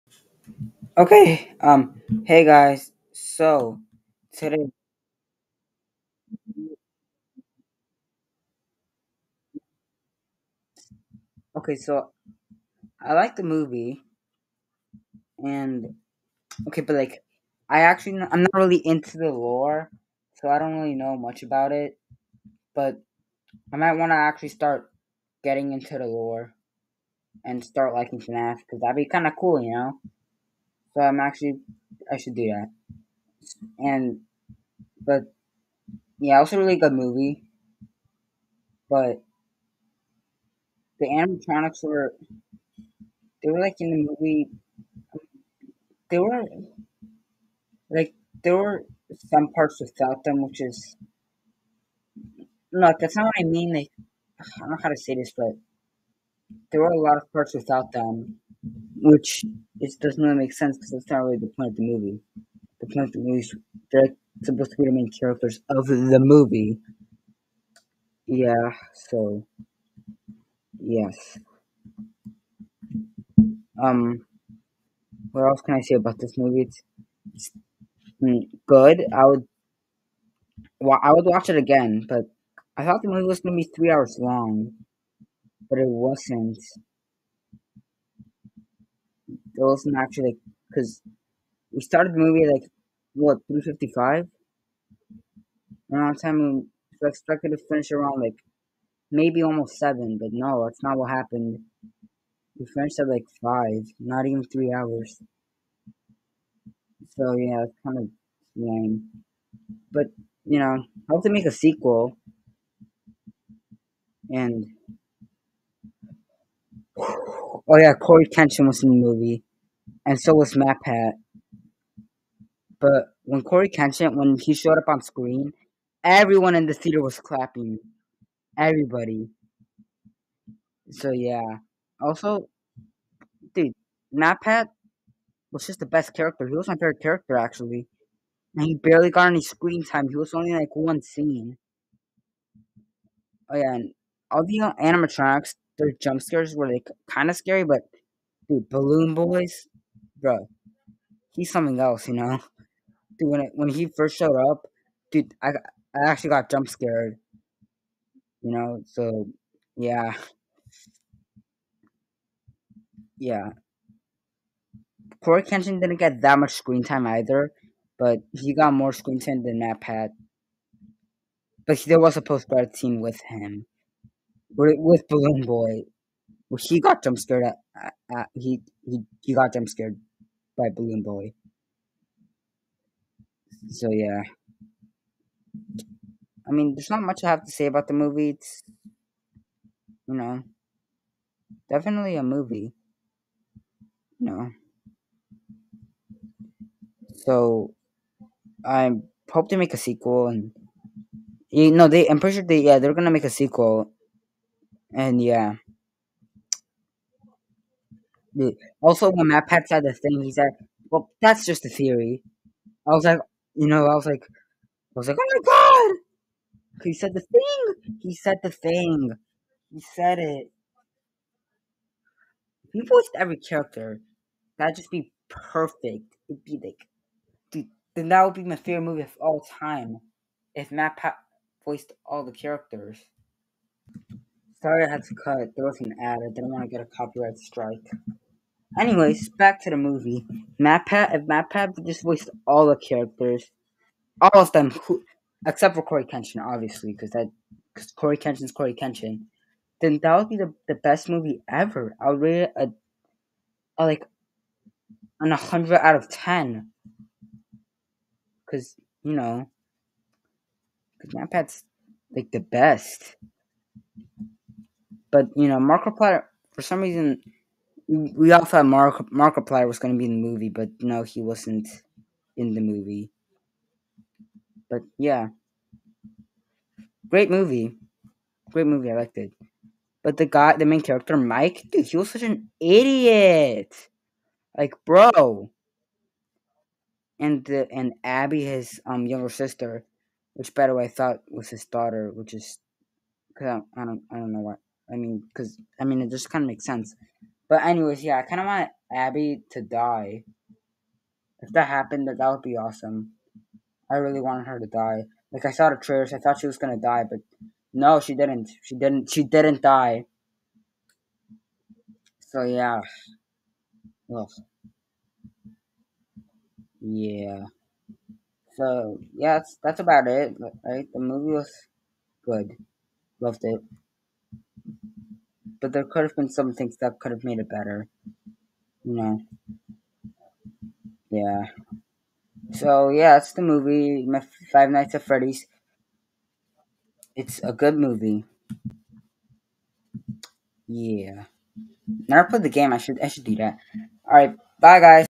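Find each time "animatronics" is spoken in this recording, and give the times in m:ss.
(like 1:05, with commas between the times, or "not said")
0:41, 2:24.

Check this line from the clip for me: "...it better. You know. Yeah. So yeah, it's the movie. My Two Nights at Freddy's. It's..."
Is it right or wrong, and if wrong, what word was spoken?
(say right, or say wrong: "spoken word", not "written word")
wrong: "Five", not "Two".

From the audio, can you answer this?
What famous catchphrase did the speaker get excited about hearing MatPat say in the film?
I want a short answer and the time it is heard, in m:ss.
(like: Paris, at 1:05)
Well, that's just a theory, at 3:30.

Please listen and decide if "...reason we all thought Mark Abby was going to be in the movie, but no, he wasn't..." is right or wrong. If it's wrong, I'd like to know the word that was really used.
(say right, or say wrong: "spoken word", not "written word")
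wrong: "Markiplier", not "Abby".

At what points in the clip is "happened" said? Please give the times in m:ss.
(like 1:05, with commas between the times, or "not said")
1:41, 5:01.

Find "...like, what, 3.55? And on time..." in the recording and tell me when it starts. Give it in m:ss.
1:32.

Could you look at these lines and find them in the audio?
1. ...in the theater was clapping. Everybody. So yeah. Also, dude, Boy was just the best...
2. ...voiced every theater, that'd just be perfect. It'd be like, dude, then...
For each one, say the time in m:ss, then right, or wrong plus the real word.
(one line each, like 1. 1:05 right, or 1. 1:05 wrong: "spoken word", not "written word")
1. 2:06 wrong: "MatPat", not "Boy"
2. 3:42 wrong: "character", not "theater".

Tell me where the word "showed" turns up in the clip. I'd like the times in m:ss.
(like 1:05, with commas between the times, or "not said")
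2:04, 2:34.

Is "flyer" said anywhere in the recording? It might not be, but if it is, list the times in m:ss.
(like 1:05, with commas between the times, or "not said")
not said.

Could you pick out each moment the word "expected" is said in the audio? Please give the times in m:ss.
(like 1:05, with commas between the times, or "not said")
1:37.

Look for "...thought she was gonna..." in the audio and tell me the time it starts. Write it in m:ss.
5:06.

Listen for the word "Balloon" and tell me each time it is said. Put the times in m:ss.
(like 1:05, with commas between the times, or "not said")
2:28, 2:55, 3:00.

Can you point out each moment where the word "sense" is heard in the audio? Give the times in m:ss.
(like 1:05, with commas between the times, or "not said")
1:00, 4:56.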